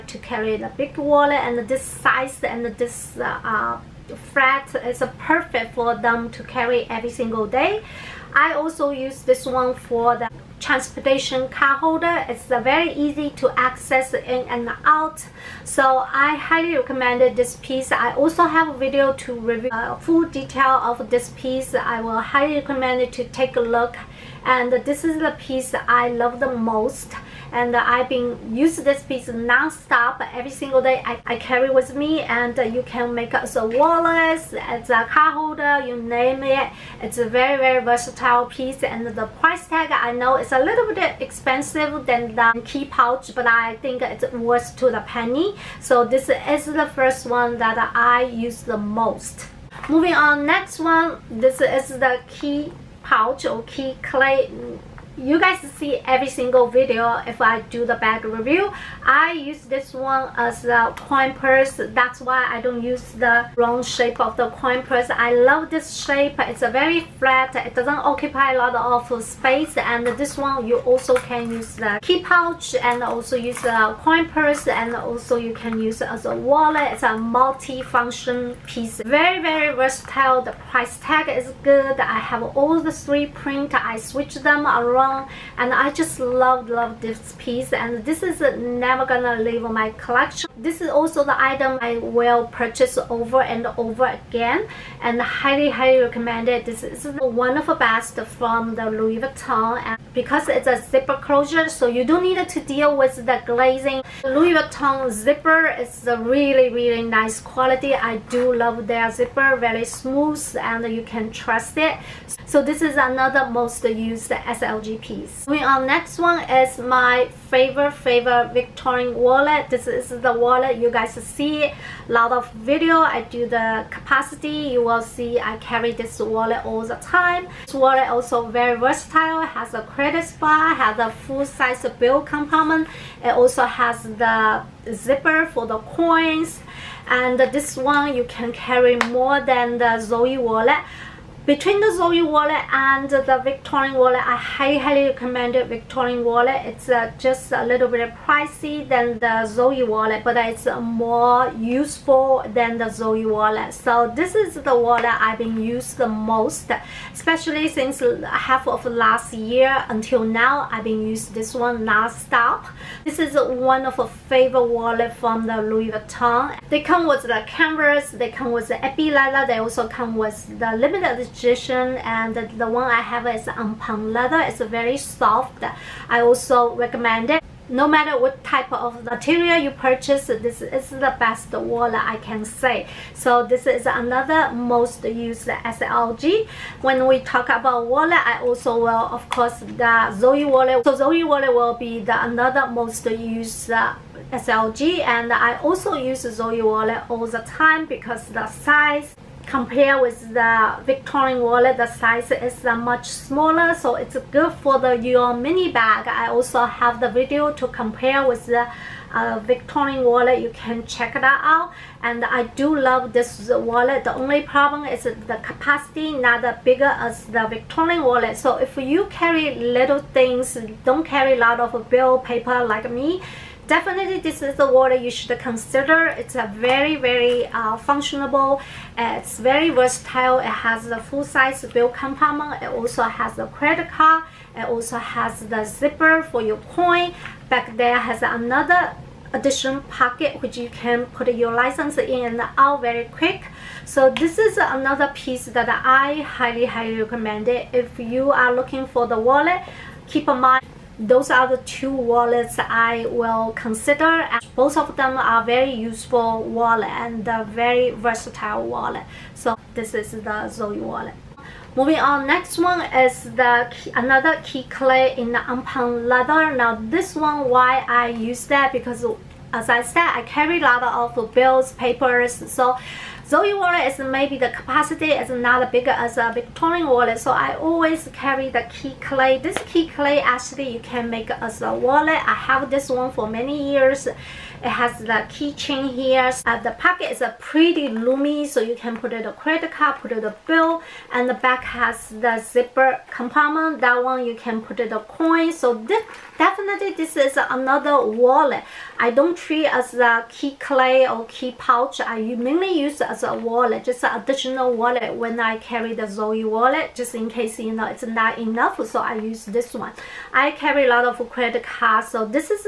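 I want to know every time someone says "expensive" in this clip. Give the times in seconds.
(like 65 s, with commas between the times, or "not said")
41 s.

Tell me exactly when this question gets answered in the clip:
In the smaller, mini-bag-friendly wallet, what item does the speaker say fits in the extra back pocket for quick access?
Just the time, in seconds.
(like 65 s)
241 s.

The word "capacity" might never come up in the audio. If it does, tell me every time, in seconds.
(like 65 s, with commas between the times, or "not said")
123 s, 215 s, 274 s.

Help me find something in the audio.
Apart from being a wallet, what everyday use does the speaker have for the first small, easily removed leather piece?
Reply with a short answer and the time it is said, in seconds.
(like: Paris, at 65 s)
Transportation card holder, at 10 s.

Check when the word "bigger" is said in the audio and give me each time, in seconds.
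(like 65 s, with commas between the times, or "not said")
216 s, 275 s.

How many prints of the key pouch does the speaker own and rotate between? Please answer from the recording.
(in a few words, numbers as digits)
3.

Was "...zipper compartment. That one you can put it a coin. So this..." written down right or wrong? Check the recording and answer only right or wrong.
right.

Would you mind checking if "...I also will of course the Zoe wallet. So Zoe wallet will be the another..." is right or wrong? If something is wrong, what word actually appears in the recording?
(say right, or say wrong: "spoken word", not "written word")
right.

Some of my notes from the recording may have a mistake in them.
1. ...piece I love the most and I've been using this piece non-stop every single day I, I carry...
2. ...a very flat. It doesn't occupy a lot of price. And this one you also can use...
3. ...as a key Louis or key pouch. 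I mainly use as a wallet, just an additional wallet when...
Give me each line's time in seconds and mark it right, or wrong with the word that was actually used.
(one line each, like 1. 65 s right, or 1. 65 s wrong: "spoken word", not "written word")
1. 25 s right
2. 66 s wrong: "space", not "price"
3. 299 s wrong: "Cles", not "Louis".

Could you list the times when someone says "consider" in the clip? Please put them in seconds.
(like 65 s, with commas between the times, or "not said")
225 s, 253 s.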